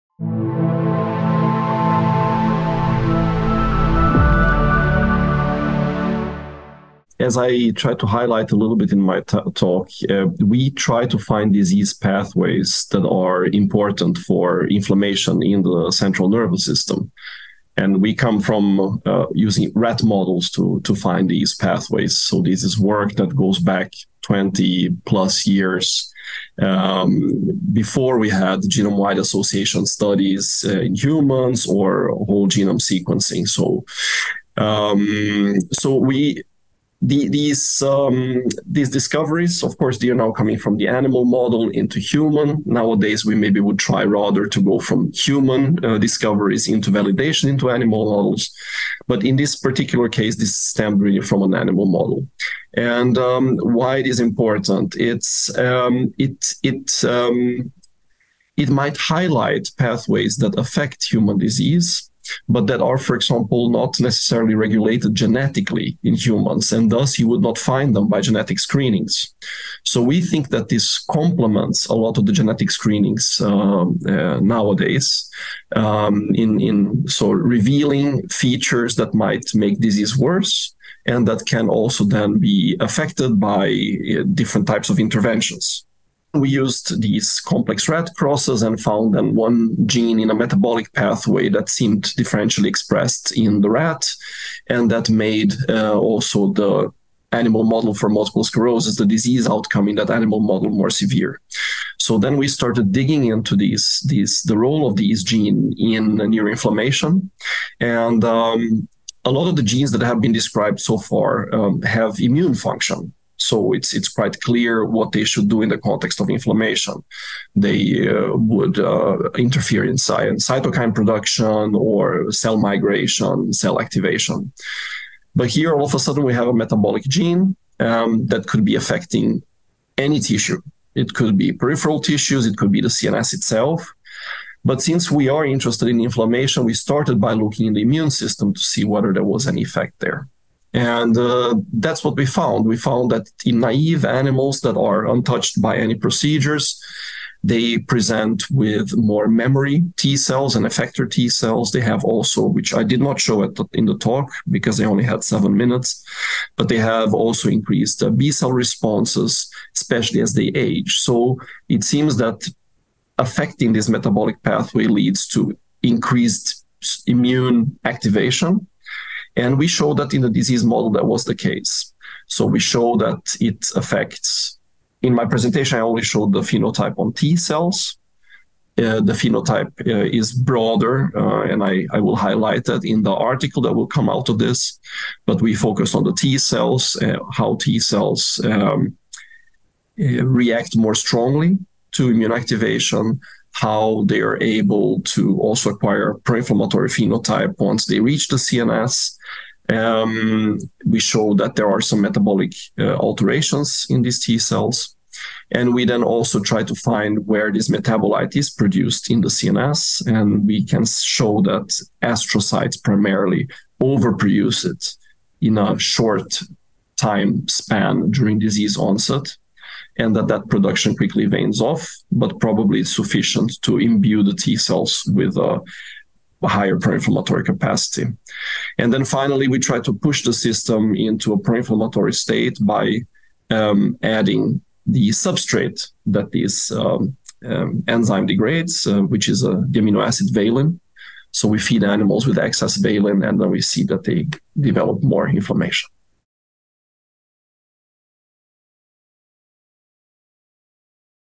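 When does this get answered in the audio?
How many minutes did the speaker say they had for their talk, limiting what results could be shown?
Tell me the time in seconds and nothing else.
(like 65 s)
155 s.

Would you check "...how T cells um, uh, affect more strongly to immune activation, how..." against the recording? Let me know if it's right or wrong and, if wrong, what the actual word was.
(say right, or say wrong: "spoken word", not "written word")
wrong: "react", not "affect".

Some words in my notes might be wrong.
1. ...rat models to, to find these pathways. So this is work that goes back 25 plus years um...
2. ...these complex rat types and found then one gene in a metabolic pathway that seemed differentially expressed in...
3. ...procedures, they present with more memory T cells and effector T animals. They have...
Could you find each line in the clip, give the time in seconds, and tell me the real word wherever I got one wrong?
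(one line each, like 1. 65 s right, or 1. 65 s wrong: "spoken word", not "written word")
1. 19 s wrong: "20", not "25"
2. 87 s wrong: "crosses", not "types"
3. 145 s wrong: "cells", not "animals".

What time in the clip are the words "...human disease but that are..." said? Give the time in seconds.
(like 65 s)
61 s.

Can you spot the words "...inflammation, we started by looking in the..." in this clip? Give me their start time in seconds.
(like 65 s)
136 s.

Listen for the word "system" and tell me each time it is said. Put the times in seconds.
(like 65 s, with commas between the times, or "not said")
16 s, 138 s, 230 s.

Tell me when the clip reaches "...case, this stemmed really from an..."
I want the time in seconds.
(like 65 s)
50 s.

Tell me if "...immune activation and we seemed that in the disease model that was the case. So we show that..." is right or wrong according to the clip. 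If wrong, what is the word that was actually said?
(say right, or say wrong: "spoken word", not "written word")
wrong: "showed", not "seemed".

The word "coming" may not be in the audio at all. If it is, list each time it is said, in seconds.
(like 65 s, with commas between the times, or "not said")
40 s.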